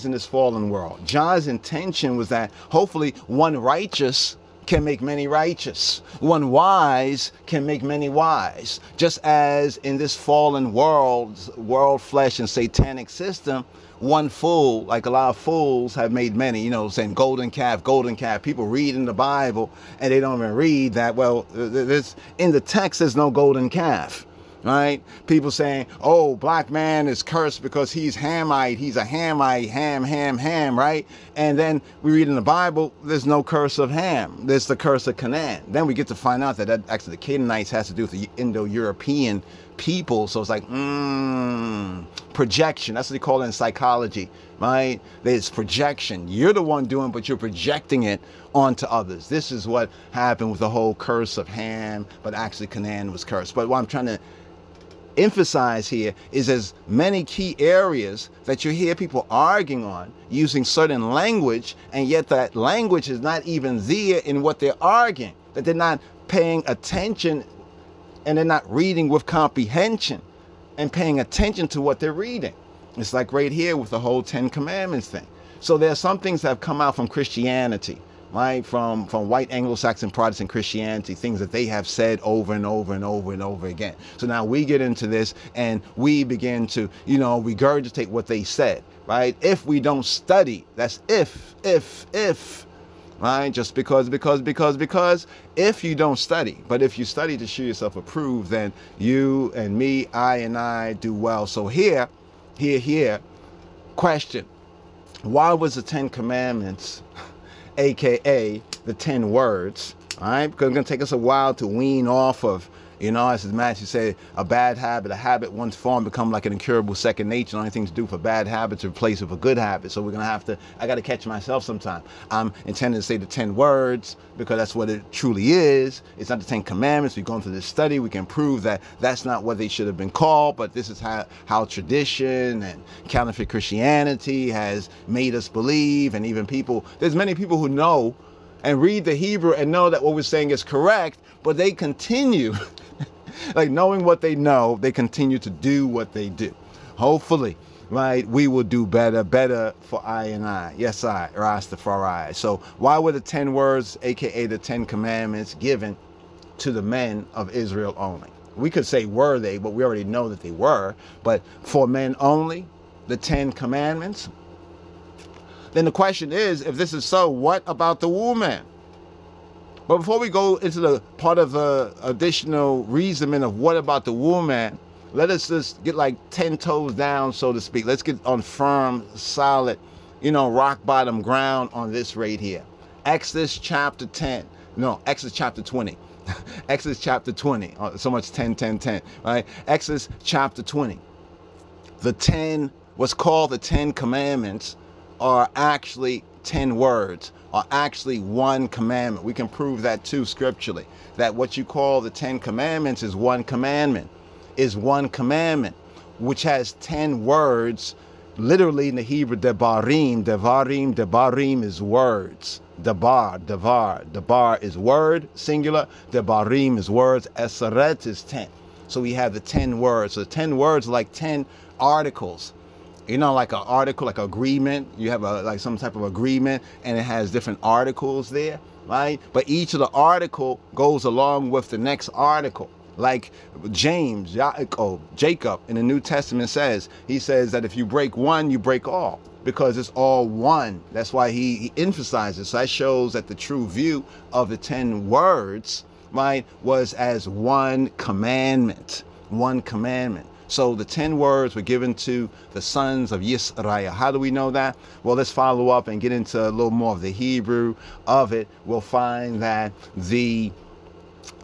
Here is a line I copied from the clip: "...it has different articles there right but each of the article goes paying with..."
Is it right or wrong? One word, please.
wrong.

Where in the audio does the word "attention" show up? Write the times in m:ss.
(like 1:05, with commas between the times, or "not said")
1:06, 1:11.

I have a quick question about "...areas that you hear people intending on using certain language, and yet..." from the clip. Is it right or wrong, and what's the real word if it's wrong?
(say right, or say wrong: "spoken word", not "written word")
wrong: "arguing", not "intending".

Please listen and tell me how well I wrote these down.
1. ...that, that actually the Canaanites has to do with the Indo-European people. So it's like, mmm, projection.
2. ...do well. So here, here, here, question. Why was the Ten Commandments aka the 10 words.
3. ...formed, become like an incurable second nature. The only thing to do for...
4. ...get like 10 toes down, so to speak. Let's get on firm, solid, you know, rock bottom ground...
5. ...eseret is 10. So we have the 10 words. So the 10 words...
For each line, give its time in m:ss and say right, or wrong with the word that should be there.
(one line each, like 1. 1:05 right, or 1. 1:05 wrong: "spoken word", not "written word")
1. 0:36 right
2. 1:40 right
3. 1:55 right
4. 2:55 right
5. 3:37 right.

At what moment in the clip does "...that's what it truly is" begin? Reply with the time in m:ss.
2:04.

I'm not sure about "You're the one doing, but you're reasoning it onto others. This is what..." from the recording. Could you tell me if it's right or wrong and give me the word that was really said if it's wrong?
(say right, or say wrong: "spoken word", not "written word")
wrong: "projecting", not "reasoning".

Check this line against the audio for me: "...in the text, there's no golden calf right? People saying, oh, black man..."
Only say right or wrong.
right.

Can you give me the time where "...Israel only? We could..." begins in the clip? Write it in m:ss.
2:37.